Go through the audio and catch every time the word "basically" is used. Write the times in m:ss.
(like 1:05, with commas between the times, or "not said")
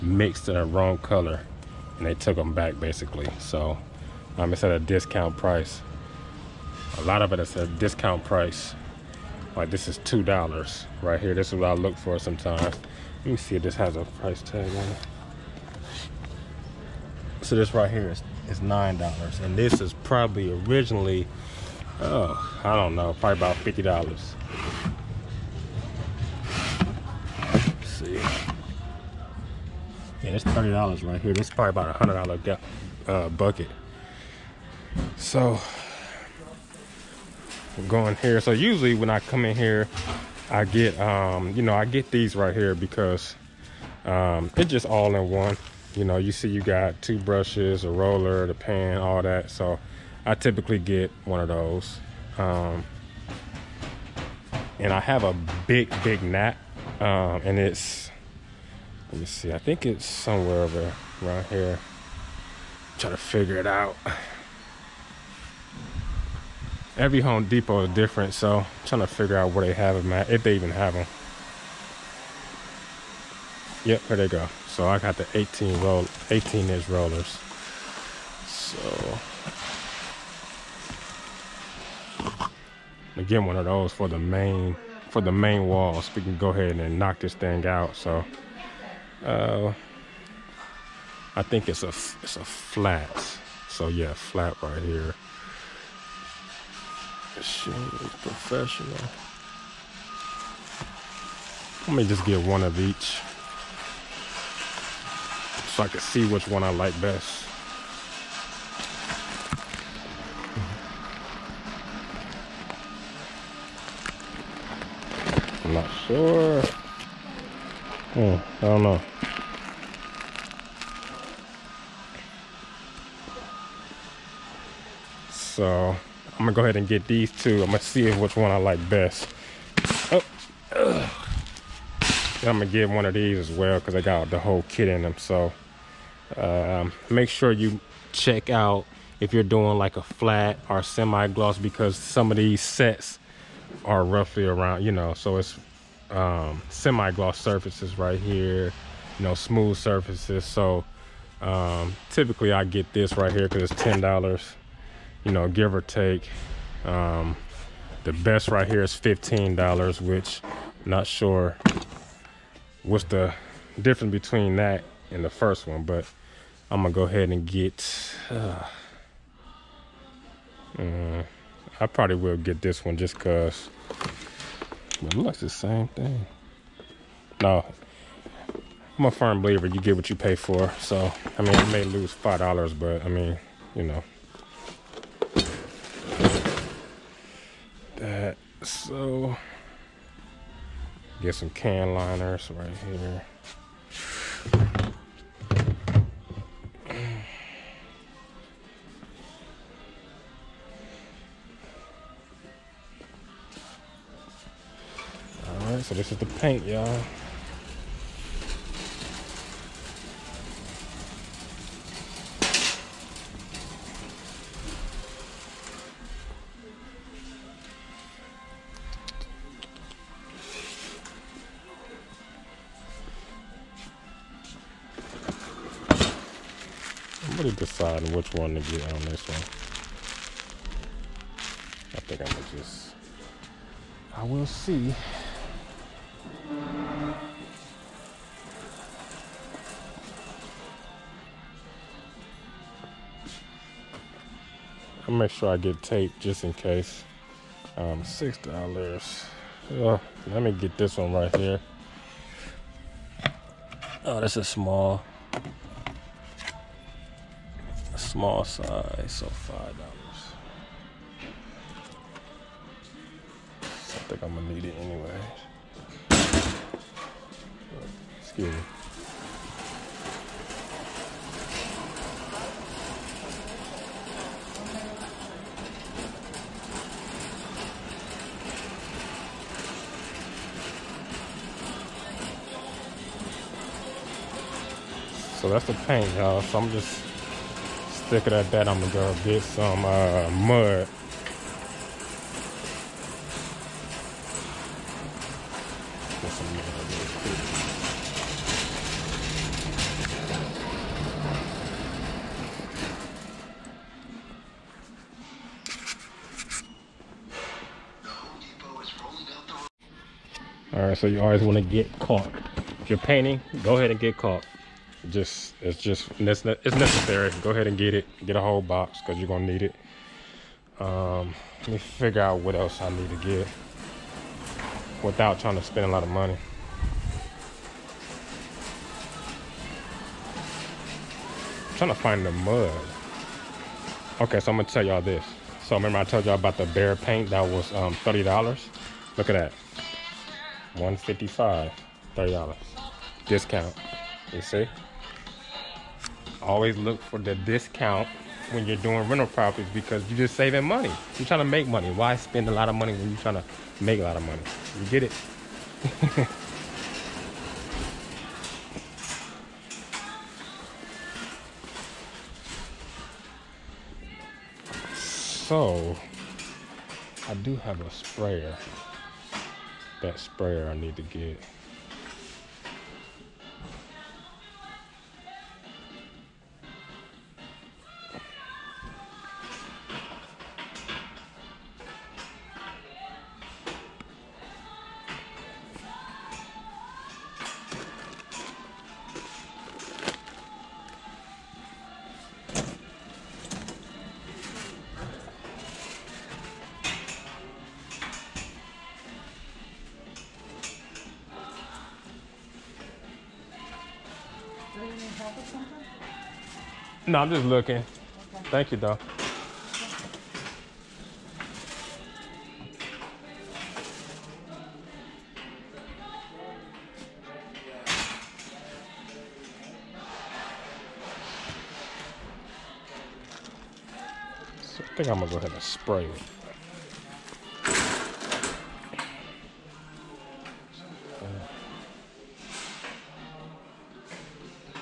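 0:02.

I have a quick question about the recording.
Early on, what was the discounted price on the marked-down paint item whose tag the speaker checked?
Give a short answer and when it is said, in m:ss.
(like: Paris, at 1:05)
$9, at 0:18.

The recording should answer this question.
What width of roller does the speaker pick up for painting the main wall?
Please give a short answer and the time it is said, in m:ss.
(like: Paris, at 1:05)
18 inch, at 1:16.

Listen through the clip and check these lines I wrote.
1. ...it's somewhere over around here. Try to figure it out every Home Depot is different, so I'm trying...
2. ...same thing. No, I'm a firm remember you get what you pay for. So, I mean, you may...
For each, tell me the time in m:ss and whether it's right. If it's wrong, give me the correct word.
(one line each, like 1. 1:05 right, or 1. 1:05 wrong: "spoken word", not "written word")
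1. 0:59 right
2. 2:55 wrong: "believer", not "remember".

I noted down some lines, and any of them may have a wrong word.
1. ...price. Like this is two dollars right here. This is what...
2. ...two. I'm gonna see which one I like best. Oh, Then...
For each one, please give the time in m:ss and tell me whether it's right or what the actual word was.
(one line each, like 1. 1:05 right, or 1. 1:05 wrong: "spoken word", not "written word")
1. 0:08 right
2. 2:07 right.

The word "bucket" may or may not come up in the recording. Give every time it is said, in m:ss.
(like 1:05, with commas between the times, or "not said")
0:33.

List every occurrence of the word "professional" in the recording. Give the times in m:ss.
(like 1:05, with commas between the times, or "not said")
1:38.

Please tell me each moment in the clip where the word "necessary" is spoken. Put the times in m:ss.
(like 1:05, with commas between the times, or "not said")
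5:16.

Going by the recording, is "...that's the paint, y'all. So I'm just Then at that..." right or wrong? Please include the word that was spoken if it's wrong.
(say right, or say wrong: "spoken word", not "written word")
wrong: "Figured", not "Then".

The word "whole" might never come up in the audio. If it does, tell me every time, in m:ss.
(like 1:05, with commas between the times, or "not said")
2:14, 5:18.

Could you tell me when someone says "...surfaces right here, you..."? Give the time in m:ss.
2:27.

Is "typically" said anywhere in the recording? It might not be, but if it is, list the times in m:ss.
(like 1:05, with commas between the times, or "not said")
0:50, 2:32.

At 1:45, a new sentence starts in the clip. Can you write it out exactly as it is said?
So I can see which one I like best.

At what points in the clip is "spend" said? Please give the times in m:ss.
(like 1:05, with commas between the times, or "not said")
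5:25, 5:52.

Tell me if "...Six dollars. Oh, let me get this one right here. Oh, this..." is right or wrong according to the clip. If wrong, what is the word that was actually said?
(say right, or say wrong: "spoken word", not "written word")
right.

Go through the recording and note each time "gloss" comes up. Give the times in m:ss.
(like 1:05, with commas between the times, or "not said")
2:20, 2:26.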